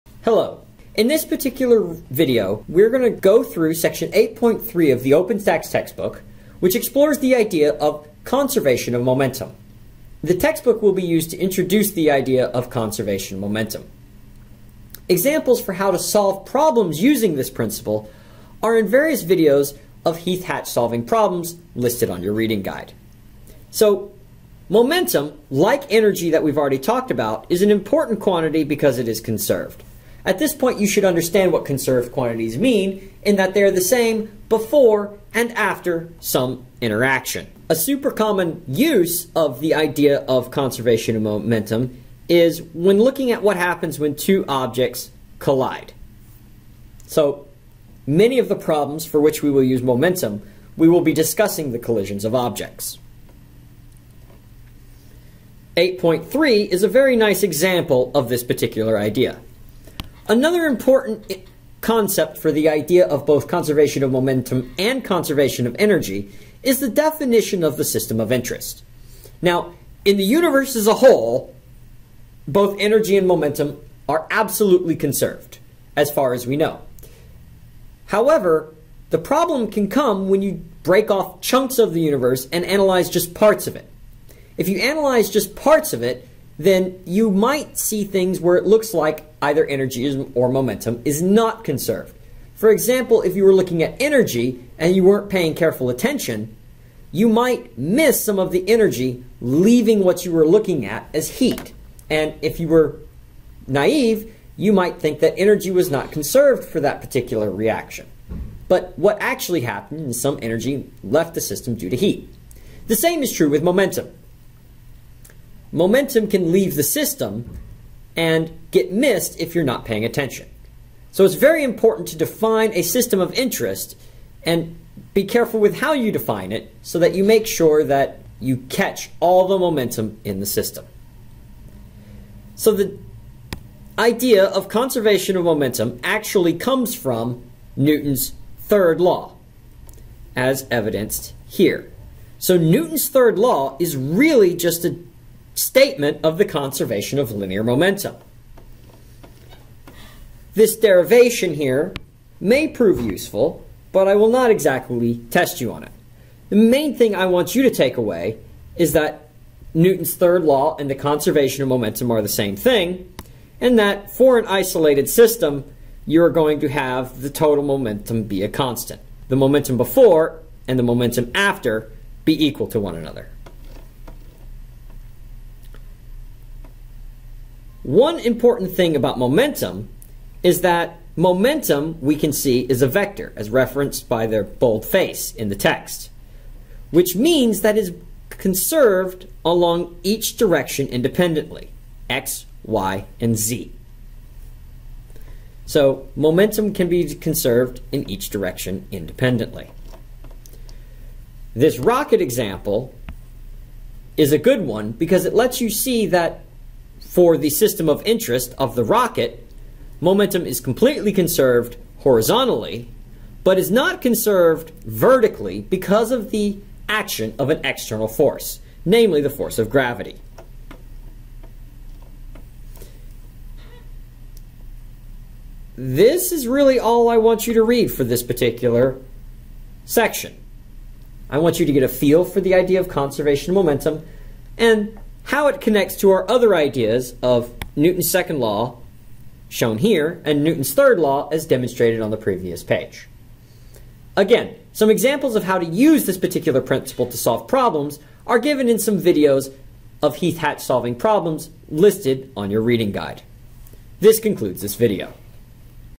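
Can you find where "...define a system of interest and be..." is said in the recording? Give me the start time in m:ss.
2:02.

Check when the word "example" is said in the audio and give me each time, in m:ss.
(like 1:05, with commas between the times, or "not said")
0:15, 0:57, 1:32, 3:22, 4:04.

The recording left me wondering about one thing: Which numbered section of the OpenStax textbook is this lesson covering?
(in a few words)
8.3.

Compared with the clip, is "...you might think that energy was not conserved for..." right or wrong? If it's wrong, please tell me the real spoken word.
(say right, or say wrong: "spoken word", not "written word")
right.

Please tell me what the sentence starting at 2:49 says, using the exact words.
The momentum before and the momentum after be equal to one another.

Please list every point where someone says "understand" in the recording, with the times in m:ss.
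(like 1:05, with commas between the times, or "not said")
0:31.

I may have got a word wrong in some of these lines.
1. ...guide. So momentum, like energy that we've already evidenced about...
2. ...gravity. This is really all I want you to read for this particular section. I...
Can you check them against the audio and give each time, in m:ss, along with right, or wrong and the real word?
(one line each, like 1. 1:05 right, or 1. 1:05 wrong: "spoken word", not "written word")
1. 0:22 wrong: "talked", not "evidenced"
2. 3:39 right.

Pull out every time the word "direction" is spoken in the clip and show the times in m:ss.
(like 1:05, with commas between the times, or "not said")
3:10, 3:18.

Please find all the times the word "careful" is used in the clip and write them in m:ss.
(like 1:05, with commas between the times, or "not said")
1:35, 2:05.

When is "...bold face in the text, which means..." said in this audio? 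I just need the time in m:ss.
3:04.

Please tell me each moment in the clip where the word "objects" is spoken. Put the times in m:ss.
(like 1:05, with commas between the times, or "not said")
0:44, 0:52.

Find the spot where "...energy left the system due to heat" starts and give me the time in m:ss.
1:50.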